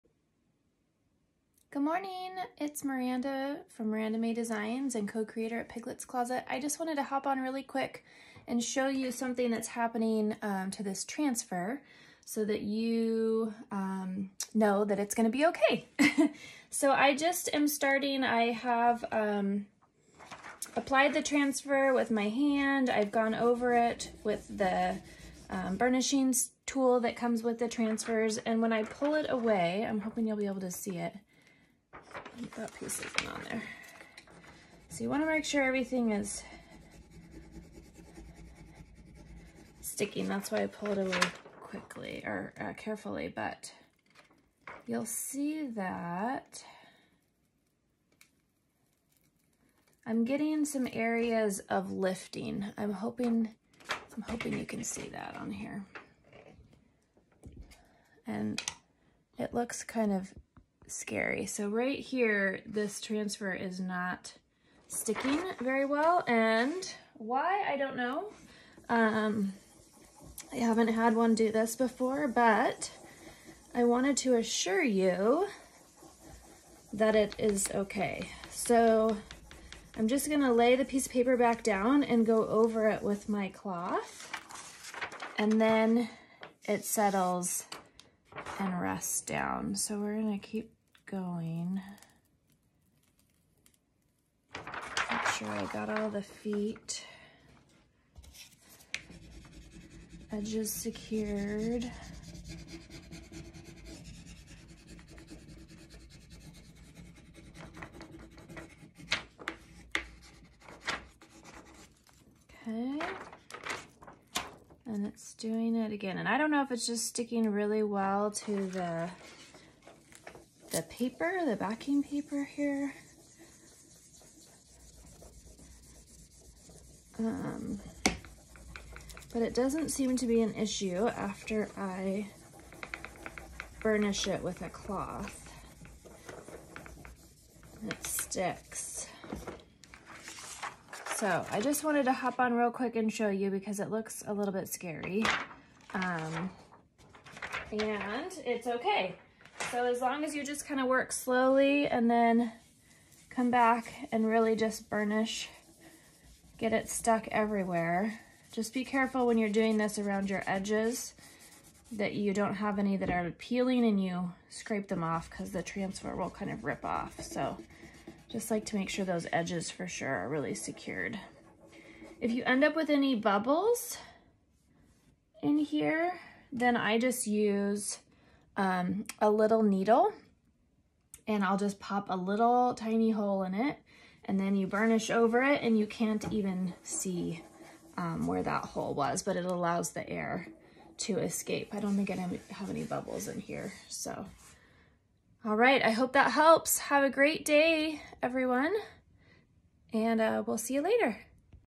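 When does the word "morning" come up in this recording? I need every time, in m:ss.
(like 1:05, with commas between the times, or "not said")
0:01.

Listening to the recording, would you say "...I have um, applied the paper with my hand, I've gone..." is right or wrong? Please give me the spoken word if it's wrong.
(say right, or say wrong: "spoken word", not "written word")
wrong: "transfer", not "paper".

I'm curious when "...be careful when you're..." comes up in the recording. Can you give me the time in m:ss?
2:38.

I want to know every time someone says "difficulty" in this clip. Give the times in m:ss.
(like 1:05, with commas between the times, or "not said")
not said.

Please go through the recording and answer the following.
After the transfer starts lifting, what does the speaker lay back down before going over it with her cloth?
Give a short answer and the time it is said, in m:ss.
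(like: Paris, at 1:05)
The piece of paper, at 1:20.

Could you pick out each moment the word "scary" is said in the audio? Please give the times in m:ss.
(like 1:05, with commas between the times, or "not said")
1:00, 2:24.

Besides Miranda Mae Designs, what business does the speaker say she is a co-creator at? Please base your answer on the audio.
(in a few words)
Piglet's Closet.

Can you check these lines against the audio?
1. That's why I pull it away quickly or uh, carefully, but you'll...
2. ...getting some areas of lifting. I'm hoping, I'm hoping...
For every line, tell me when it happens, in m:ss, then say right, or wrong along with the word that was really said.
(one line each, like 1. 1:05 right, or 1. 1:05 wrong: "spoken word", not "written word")
1. 0:40 right
2. 0:50 right.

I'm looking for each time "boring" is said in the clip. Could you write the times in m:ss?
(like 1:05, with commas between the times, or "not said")
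not said.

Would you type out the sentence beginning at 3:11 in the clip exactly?
I don't think I have any bubbles in here, so.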